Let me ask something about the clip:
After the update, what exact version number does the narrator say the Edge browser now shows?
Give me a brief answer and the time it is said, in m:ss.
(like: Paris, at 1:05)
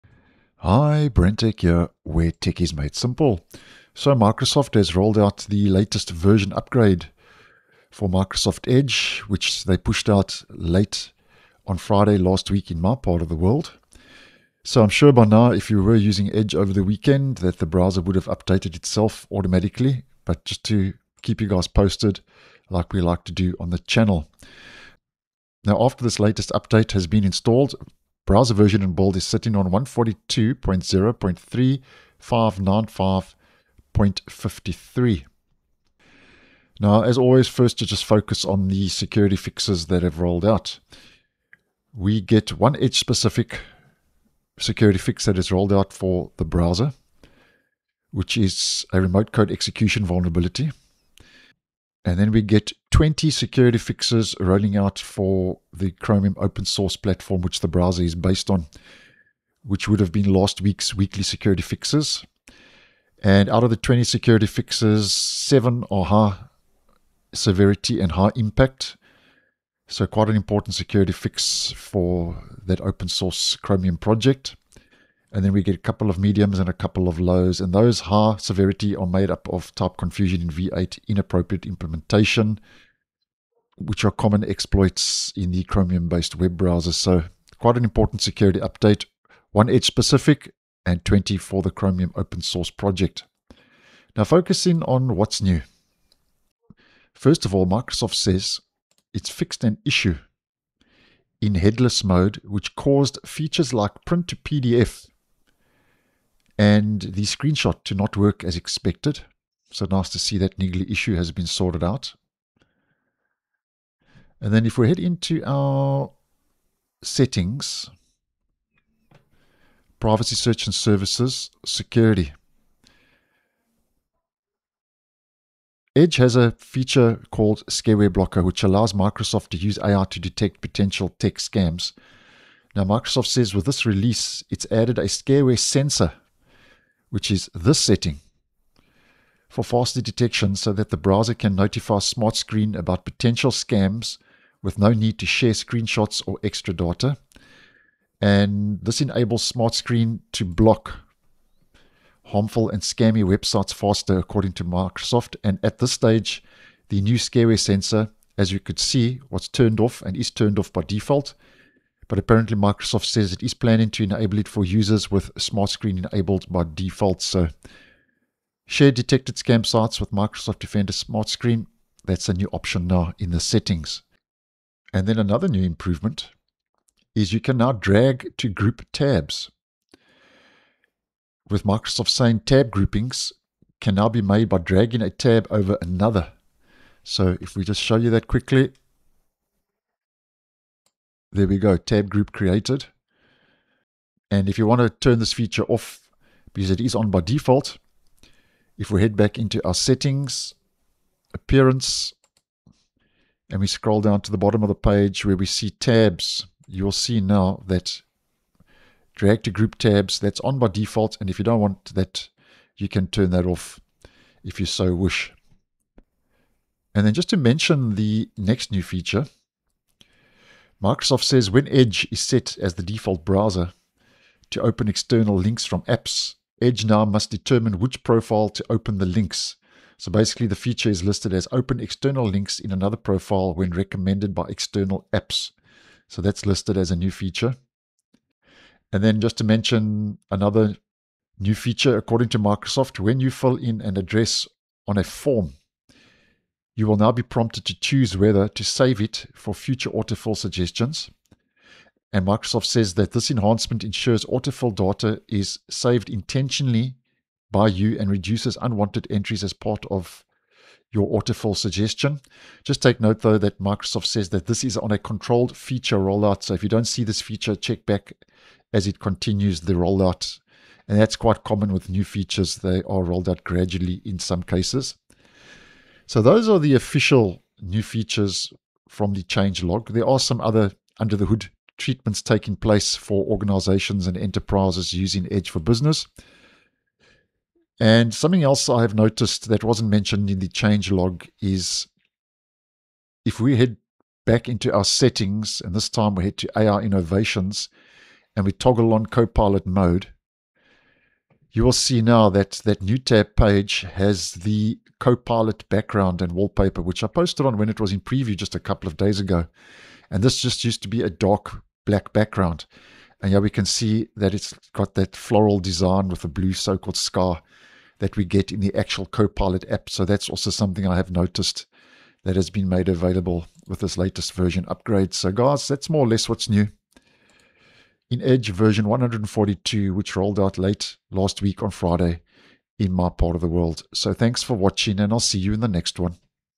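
142.0.3595.53, at 0:29.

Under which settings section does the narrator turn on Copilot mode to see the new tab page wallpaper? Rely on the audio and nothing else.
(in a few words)
AI Innovations.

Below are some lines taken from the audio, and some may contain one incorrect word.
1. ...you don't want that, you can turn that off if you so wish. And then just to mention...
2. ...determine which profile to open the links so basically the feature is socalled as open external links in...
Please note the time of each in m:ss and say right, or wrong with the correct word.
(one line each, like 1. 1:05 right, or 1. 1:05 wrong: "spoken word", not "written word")
1. 3:31 right
2. 3:47 wrong: "listed", not "socalled".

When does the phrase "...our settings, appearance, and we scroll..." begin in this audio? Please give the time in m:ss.
3:19.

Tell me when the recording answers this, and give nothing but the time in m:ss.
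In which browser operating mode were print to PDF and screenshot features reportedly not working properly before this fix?
1:41.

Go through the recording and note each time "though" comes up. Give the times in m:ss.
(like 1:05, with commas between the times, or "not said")
4:23.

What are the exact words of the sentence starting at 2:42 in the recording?
But apparently, Microsoft says it is planning to enable it for users with Smart Screen enabled by default.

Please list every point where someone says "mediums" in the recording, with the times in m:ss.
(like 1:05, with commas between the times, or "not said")
1:16.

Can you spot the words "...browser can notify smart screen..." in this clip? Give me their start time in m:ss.
2:20.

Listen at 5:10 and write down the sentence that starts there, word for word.
And this just used to be a dark black background.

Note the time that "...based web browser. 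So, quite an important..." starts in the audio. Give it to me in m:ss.
1:26.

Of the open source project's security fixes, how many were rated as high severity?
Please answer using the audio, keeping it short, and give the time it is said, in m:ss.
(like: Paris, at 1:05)
7, at 1:05.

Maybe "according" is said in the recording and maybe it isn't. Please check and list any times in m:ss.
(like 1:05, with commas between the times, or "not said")
2:34, 4:01.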